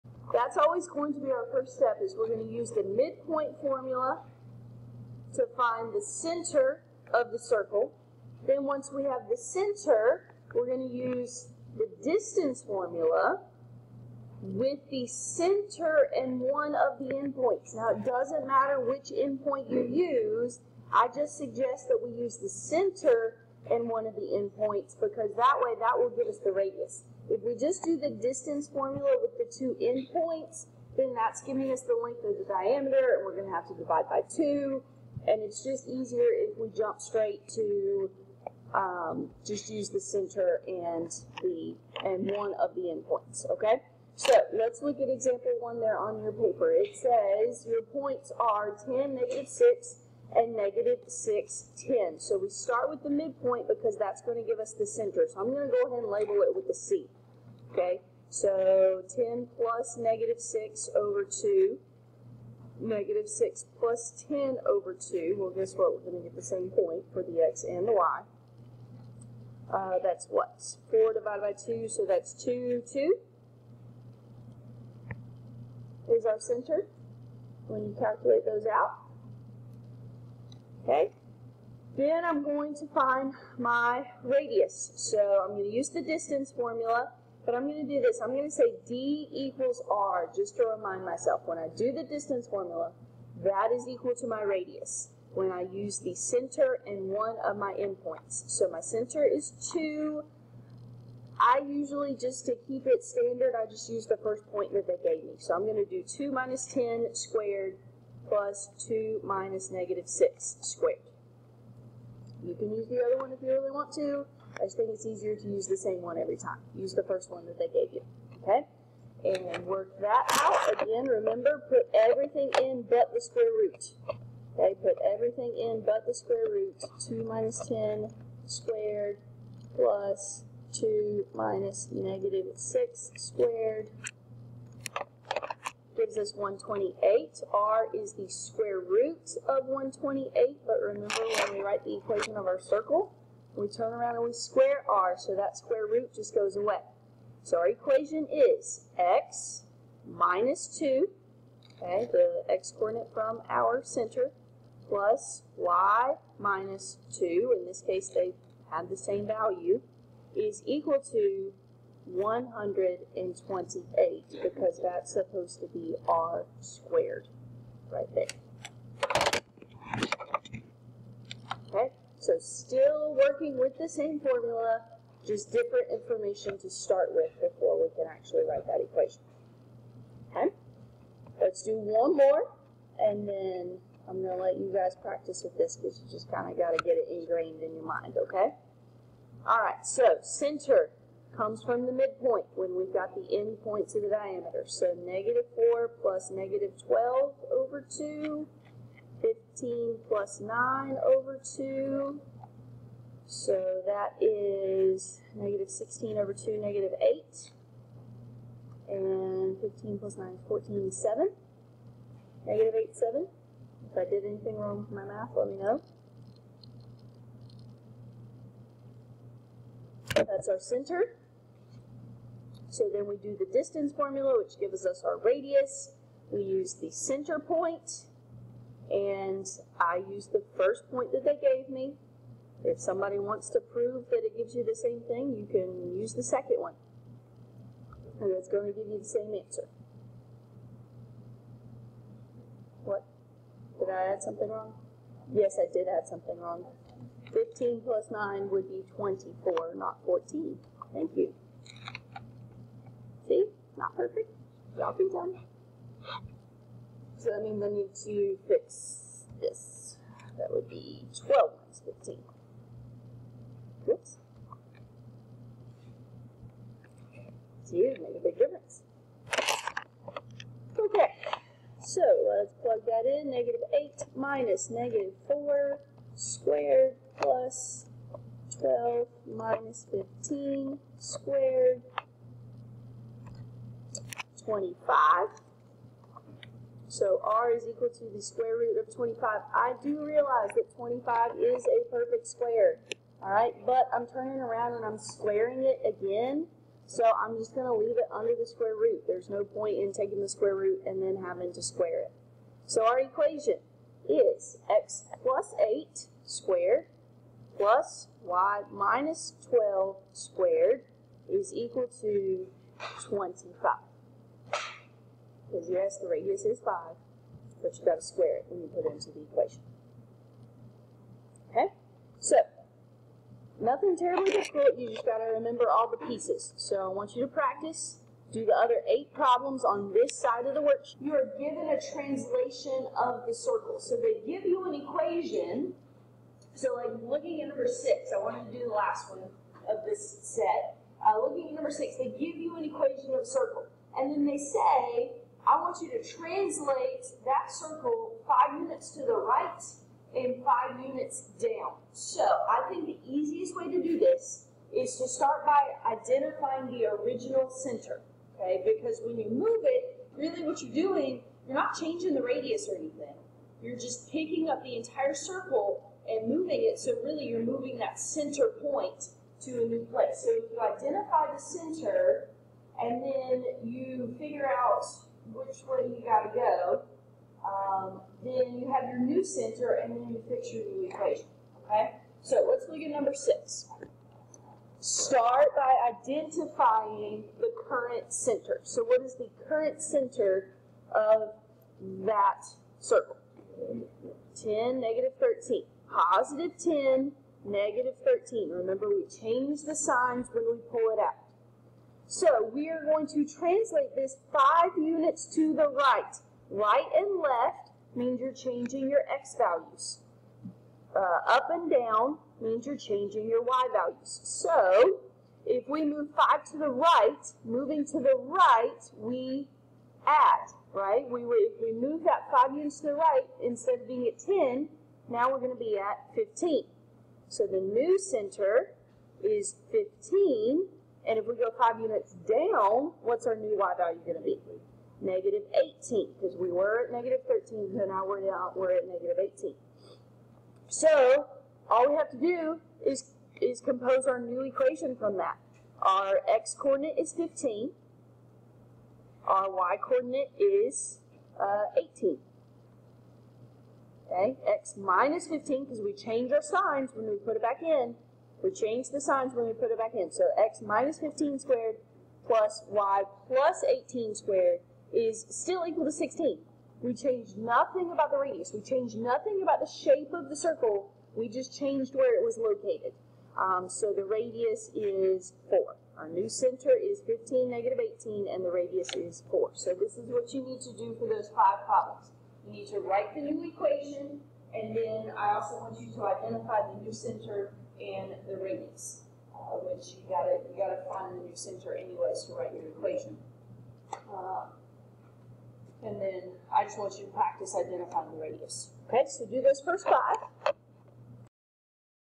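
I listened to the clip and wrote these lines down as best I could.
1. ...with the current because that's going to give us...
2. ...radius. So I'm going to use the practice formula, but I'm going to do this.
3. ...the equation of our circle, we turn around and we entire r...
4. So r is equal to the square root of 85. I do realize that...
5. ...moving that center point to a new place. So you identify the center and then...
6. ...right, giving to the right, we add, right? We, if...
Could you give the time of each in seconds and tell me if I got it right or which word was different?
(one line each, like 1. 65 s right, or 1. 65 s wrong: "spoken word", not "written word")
1. 52 s wrong: "midpoint", not "current"
2. 84 s wrong: "distance", not "practice"
3. 141 s wrong: "square", not "entire"
4. 286 s wrong: "25", not "85"
5. 367 s right
6. 416 s wrong: "moving", not "giving".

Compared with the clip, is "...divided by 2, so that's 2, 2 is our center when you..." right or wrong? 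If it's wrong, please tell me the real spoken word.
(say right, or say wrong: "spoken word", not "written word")
right.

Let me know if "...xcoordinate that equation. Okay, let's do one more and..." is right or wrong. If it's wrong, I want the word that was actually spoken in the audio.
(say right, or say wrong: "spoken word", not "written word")
wrong: "write", not "xcoordinate".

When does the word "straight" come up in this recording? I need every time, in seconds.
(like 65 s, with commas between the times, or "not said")
36 s.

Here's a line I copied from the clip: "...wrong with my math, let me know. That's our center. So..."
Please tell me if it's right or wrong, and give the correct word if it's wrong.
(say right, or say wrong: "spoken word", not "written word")
right.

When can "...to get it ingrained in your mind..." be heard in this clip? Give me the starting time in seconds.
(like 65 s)
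186 s.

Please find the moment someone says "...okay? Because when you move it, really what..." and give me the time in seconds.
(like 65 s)
358 s.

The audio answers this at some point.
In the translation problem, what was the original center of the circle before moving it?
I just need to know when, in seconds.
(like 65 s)
395 s.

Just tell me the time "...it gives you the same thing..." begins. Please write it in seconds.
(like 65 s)
234 s.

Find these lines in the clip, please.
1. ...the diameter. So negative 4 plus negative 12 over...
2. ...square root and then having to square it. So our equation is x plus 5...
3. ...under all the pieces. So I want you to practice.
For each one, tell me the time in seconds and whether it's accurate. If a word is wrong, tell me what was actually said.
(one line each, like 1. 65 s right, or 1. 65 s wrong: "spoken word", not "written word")
1. 194 s right
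2. 300 s wrong: "8", not "5"
3. 325 s wrong: "remember", not "under".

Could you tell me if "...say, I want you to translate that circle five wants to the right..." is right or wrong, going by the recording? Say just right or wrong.
wrong.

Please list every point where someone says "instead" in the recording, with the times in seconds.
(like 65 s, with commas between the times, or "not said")
423 s.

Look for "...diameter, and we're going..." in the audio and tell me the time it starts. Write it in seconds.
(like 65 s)
32 s.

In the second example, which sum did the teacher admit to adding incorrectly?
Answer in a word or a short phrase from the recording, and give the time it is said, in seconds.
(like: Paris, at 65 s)
15 plus 9, at 247 s.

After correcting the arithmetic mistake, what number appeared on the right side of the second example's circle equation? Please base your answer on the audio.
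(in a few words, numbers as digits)
25.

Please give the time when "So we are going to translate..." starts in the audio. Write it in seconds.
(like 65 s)
402 s.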